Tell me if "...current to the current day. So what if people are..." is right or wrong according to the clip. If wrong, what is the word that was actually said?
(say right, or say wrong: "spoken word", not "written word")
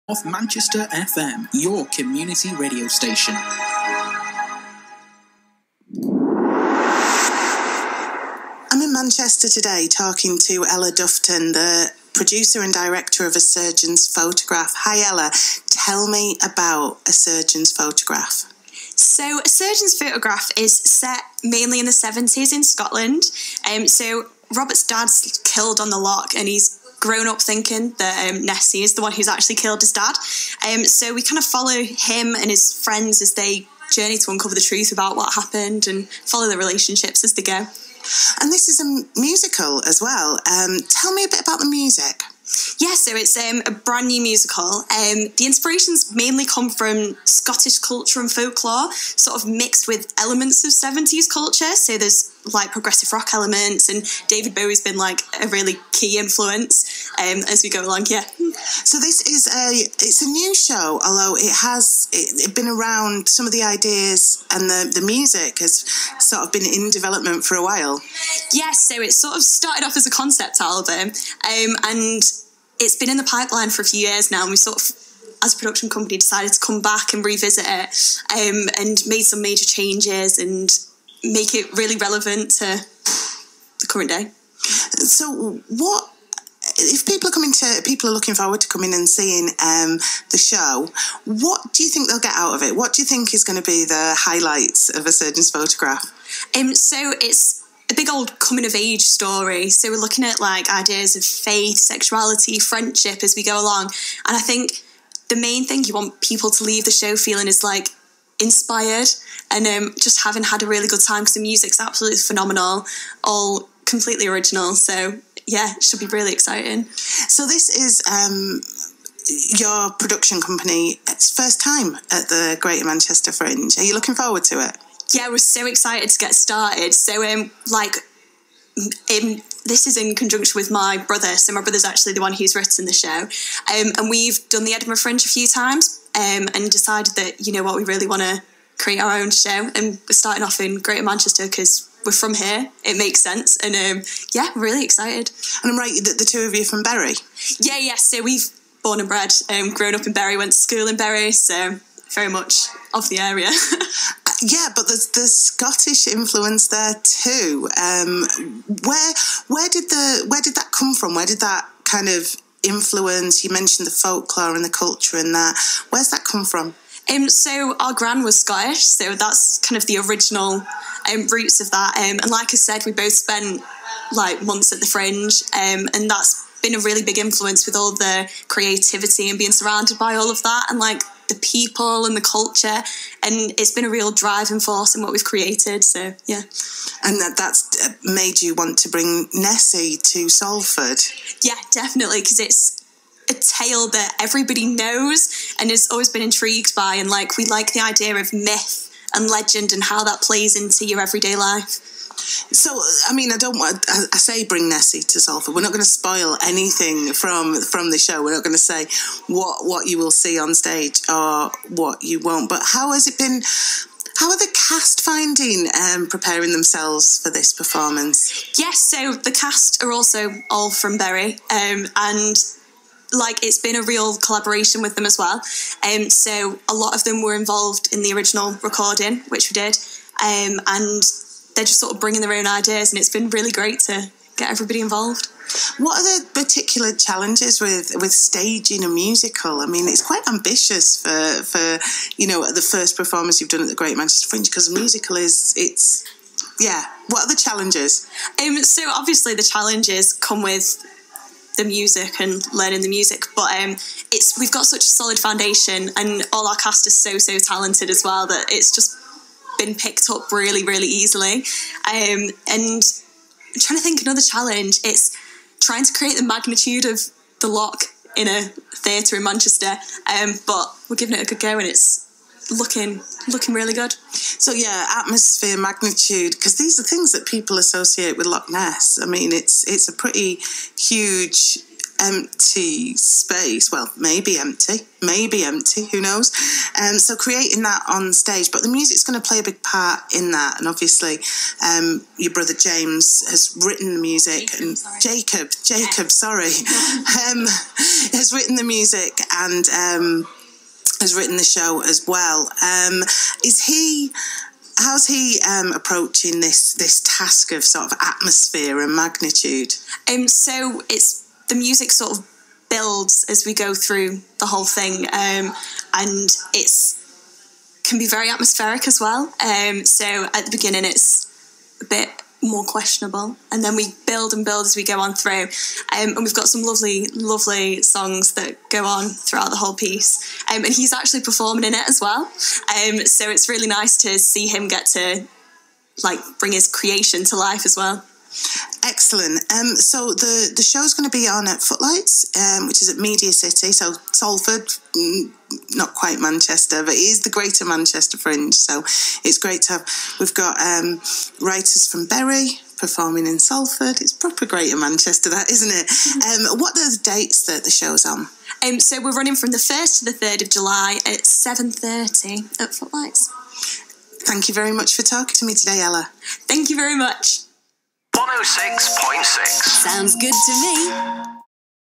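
wrong: "relevant", not "current".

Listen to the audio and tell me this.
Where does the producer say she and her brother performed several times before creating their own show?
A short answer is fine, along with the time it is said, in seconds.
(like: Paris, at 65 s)
Edinburgh Fringe, at 134 s.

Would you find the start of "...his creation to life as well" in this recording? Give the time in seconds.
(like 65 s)
336 s.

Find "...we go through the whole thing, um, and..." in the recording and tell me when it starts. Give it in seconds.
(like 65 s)
313 s.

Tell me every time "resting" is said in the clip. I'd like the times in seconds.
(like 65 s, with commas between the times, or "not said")
not said.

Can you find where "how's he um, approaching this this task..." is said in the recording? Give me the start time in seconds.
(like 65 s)
304 s.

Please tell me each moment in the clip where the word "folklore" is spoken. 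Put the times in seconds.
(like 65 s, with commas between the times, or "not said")
48 s, 163 s.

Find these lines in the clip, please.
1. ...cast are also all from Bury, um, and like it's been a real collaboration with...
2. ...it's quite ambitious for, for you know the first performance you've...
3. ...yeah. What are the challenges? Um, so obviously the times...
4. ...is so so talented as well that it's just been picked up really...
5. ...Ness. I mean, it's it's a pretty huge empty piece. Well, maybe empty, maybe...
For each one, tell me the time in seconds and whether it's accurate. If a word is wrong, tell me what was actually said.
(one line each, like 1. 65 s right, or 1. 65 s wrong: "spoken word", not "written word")
1. 219 s right
2. 239 s right
3. 246 s wrong: "challenges", not "times"
4. 256 s right
5. 278 s wrong: "space", not "piece".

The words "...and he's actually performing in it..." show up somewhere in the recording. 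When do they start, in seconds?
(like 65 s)
330 s.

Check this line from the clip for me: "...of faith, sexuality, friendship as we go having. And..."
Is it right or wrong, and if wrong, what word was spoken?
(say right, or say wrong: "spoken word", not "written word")
wrong: "along", not "having".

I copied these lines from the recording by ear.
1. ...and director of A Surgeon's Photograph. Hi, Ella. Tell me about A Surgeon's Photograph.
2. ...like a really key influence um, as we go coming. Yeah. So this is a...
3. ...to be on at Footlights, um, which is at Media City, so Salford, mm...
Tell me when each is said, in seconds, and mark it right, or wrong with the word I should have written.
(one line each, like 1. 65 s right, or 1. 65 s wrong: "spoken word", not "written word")
1. 12 s right
2. 54 s wrong: "along", not "coming"
3. 341 s right.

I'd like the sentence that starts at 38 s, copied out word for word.
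And this is a musical as well.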